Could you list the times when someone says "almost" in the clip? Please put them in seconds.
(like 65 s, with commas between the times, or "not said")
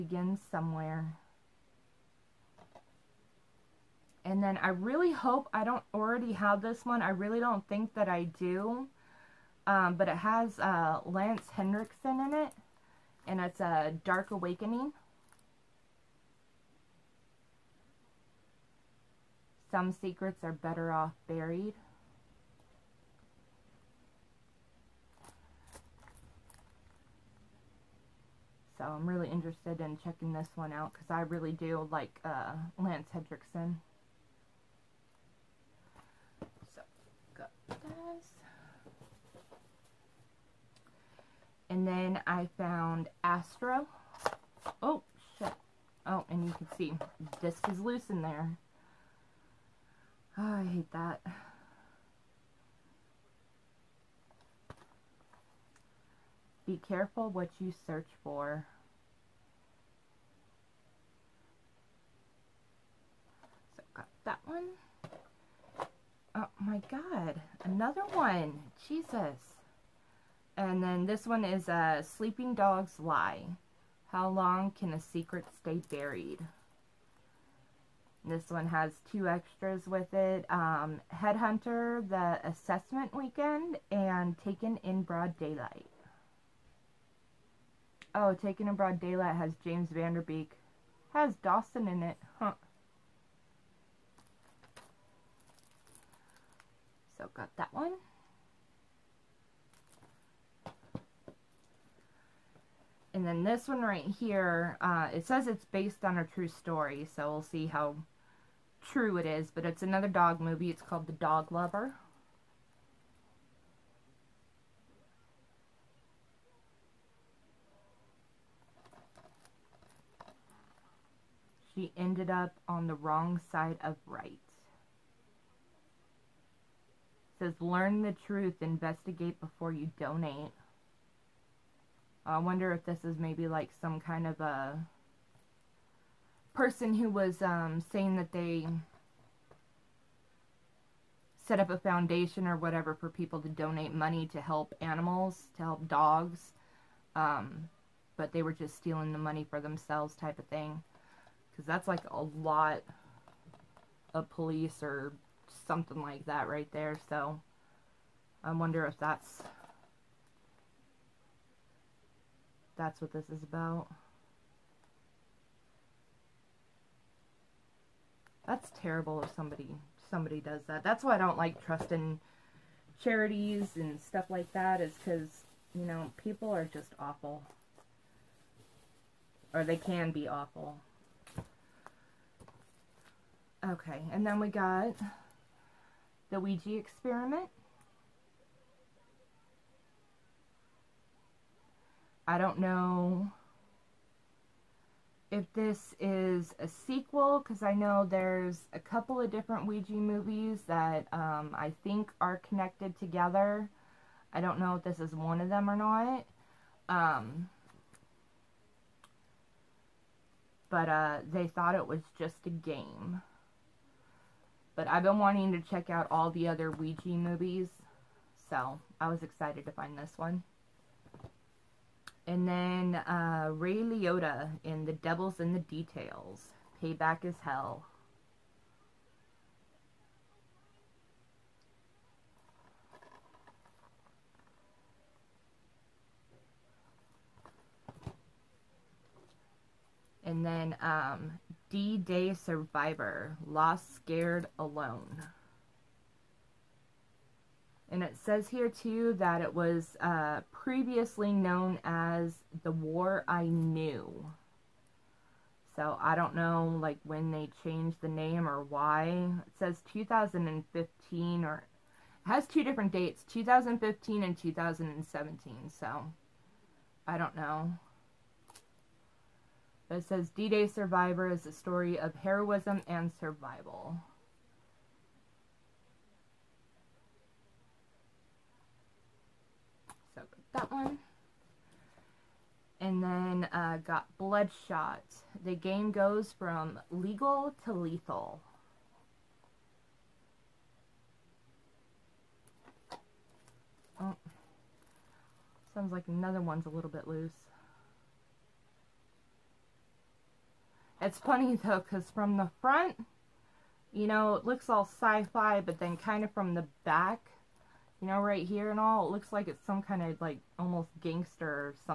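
310 s.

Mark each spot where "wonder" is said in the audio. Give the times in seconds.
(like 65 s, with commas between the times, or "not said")
132 s, 158 s.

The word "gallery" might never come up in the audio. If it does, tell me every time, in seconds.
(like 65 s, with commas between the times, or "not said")
not said.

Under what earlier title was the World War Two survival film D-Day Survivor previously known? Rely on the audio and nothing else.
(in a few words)
The War I Knew.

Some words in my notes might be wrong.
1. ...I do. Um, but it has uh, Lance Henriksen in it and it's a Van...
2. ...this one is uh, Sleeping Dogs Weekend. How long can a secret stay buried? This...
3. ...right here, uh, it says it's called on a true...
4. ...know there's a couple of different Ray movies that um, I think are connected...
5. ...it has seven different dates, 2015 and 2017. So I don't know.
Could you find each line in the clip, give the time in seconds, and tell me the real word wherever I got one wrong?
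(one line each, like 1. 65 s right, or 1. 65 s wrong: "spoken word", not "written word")
1. 8 s wrong: "Dark", not "Van"
2. 71 s wrong: "Lie", not "Weekend"
3. 103 s wrong: "based", not "called"
4. 197 s wrong: "Ouija", not "Ray"
5. 262 s wrong: "two", not "seven".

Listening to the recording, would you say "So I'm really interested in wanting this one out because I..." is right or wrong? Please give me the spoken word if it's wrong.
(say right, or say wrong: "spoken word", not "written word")
wrong: "checking", not "wanting".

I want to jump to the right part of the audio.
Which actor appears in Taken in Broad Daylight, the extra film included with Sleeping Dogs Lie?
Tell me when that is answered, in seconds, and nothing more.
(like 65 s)
89 s.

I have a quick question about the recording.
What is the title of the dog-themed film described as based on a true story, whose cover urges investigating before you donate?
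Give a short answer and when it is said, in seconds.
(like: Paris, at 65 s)
The Dog Lover, at 111 s.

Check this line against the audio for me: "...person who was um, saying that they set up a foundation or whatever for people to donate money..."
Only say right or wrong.
right.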